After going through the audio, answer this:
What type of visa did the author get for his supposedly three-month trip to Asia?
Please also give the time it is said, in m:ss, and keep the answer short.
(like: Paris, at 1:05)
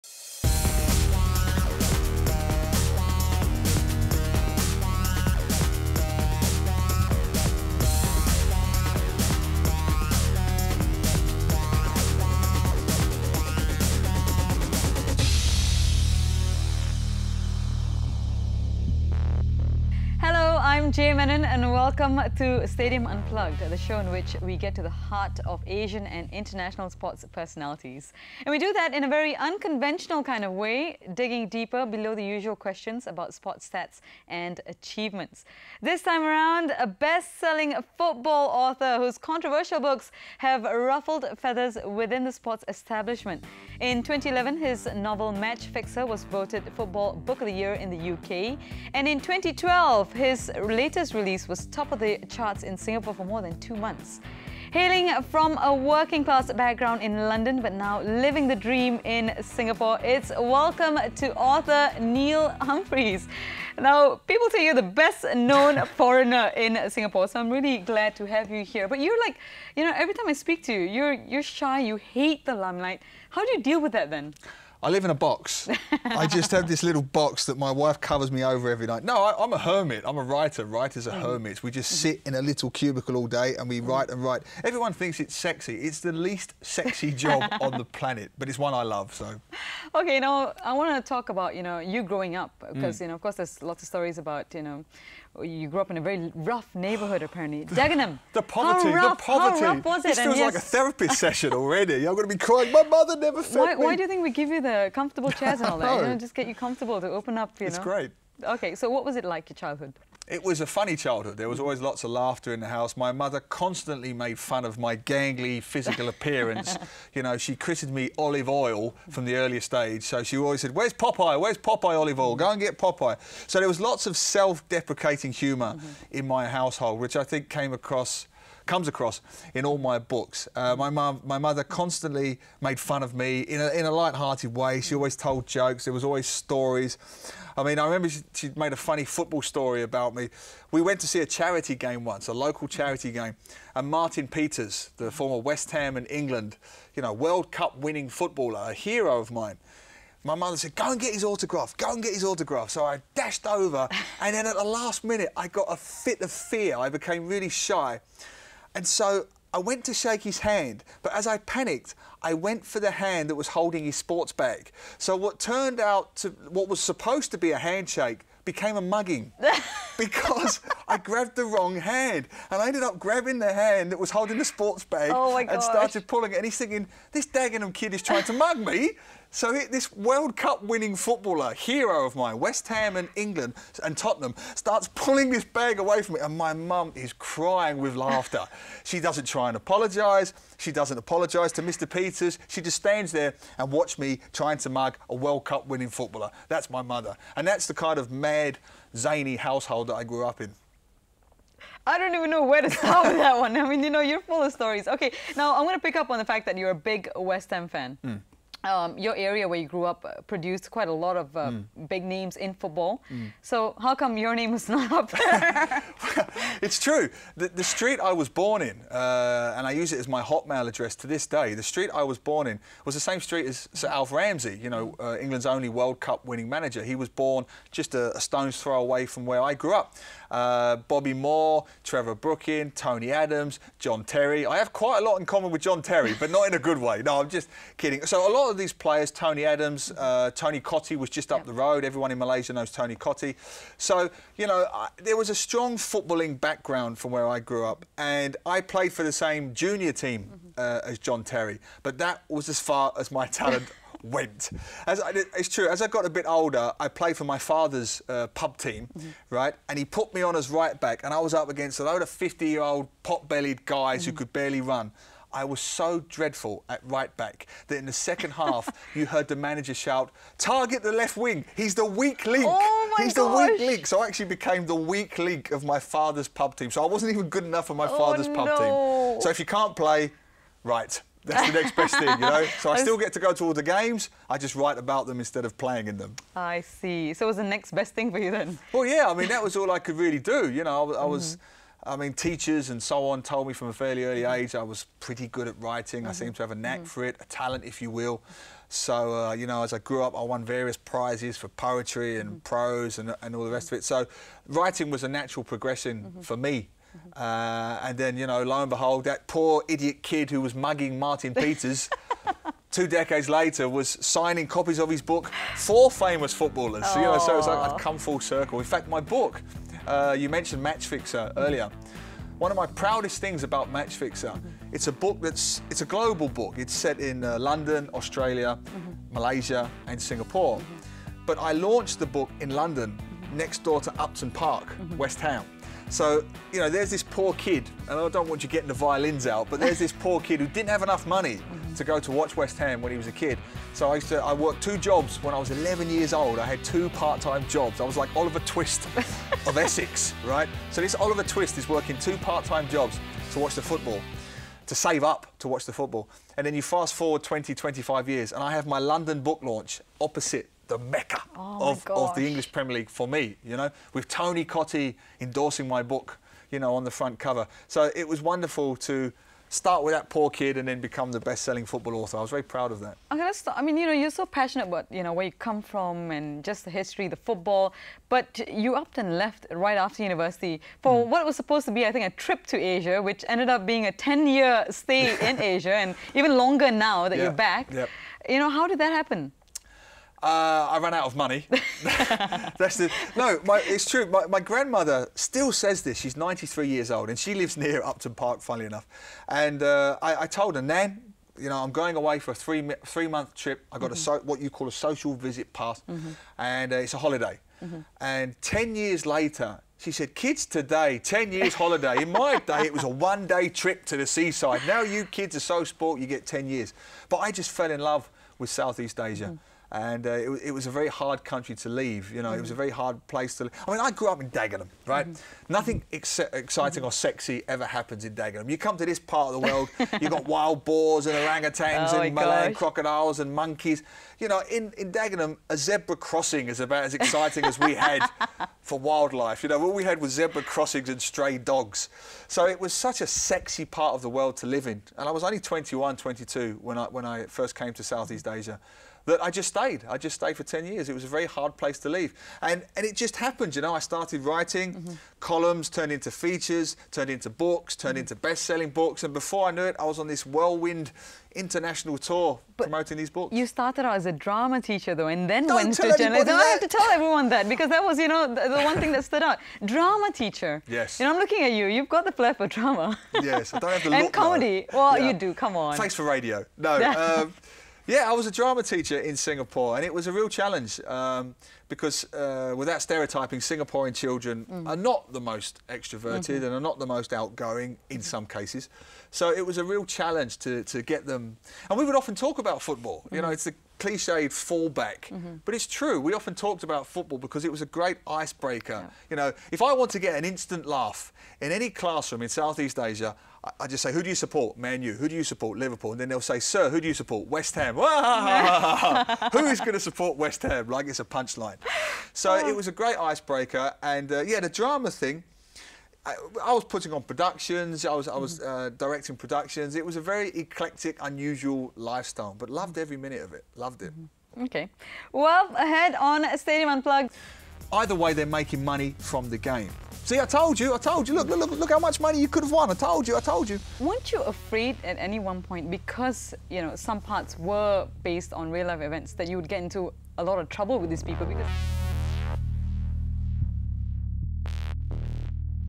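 Social visit pass, at 6:44.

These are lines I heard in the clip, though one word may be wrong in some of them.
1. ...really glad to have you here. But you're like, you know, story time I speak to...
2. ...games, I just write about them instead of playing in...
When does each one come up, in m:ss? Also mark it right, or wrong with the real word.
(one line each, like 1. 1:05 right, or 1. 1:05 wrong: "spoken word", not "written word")
1. 1:07 wrong: "every", not "story"
2. 4:43 right.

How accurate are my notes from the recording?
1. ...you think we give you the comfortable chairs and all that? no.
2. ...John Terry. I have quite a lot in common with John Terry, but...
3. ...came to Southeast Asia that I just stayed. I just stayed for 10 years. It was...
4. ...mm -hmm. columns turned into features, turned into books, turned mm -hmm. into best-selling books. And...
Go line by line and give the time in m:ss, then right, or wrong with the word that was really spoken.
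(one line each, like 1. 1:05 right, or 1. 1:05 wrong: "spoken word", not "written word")
1. 1:44 right
2. 3:53 right
3. 7:27 right
4. 7:34 right.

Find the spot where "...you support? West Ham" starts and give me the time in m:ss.
8:26.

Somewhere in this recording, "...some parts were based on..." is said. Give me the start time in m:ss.
8:56.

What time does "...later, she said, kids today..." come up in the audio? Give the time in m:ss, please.
6:49.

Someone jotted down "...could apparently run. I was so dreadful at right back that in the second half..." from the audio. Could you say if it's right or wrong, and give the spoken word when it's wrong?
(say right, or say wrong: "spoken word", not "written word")
wrong: "barely", not "apparently".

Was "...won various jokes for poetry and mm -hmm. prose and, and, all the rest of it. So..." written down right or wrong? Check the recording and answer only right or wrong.
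wrong.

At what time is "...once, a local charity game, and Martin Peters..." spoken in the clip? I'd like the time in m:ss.
2:22.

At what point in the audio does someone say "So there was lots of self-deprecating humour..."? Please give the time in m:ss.
2:03.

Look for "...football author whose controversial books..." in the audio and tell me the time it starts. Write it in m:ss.
0:37.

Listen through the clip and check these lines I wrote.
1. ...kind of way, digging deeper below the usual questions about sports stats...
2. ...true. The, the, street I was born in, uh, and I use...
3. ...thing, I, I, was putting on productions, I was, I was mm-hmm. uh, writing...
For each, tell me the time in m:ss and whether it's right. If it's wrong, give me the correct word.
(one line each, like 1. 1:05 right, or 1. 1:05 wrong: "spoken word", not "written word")
1. 0:30 right
2. 3:36 right
3. 8:34 wrong: "directing", not "writing".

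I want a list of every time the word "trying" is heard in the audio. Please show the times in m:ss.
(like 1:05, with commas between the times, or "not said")
2:58, 3:14.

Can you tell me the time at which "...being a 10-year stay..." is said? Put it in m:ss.
6:23.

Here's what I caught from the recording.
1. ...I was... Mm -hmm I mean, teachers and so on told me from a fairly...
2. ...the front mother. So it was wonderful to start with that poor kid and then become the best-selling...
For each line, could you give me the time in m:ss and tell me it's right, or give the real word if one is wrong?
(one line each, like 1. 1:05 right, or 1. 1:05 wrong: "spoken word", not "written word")
1. 4:51 right
2. 6:06 wrong: "cover", not "mother".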